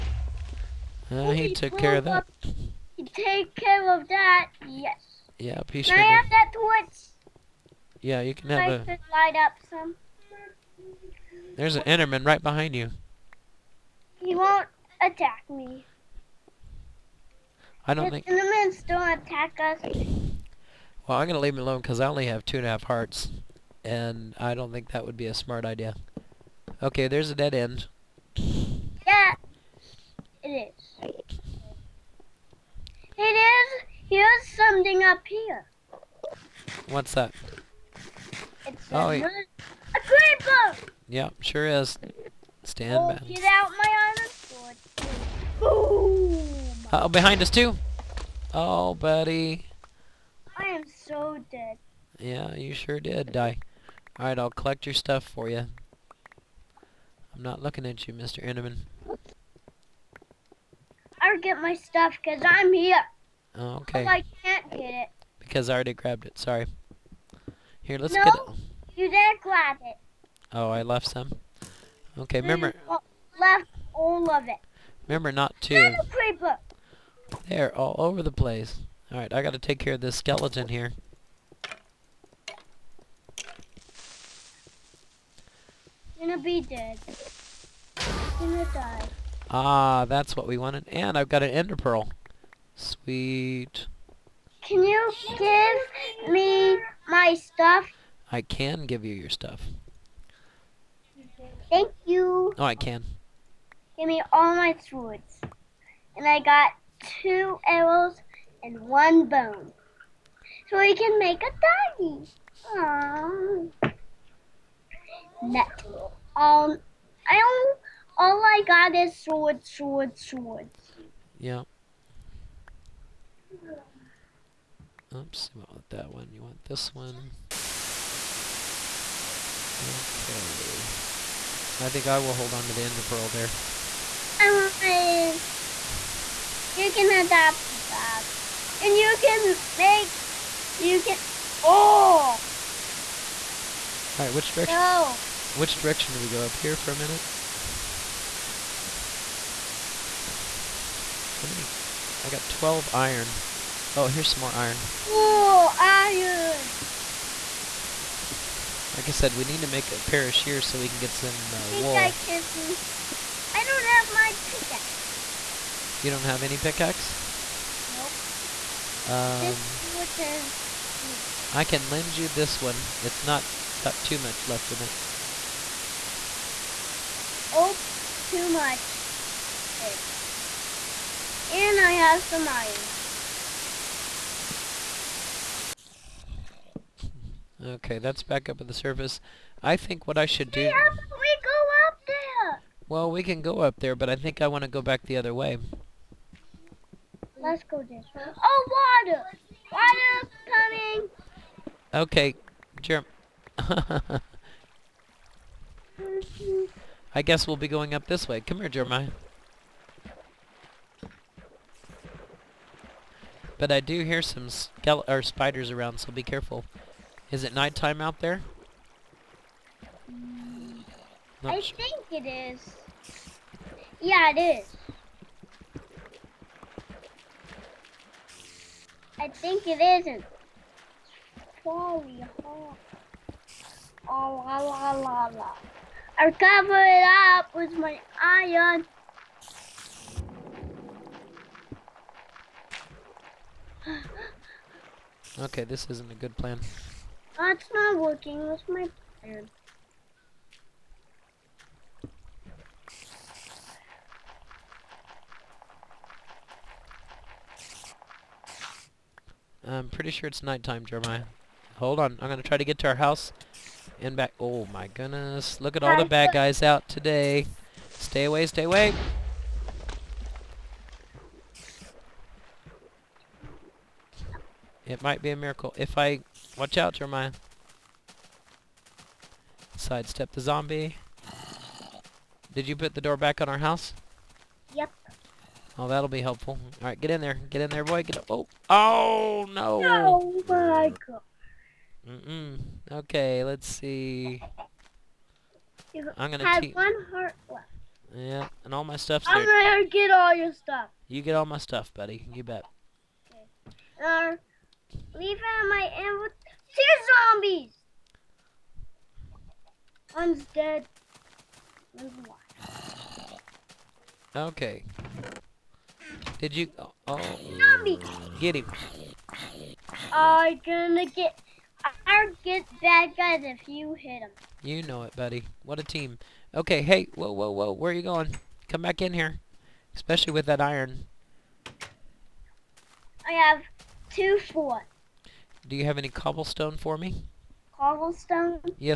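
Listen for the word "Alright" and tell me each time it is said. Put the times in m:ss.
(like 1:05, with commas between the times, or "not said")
0:54, 2:24.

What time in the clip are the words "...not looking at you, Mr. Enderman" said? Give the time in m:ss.
0:57.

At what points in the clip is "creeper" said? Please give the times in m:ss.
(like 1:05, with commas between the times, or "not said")
0:40, 1:16.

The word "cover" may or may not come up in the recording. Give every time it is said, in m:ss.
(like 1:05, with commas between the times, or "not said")
3:56.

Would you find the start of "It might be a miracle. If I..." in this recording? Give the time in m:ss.
4:34.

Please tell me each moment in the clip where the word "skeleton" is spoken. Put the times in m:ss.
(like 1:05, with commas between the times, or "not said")
1:20.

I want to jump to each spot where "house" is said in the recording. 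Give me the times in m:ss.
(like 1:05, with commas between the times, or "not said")
4:22, 4:43.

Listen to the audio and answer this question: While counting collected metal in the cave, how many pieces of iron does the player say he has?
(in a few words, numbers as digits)
12.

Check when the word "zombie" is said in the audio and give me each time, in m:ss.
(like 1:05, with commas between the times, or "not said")
4:40, 5:07, 5:17.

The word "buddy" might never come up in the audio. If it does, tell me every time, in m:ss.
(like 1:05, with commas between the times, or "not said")
0:48, 5:01, 5:25.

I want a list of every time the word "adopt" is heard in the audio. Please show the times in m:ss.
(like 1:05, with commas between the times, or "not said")
2:17.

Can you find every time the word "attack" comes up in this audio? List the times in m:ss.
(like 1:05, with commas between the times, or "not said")
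0:15, 0:19.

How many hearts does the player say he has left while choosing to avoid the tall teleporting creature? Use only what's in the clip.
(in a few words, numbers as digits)
2.5.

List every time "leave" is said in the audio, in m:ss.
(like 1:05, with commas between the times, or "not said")
0:21, 5:05.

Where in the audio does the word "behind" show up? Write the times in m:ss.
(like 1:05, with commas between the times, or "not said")
0:12, 0:47.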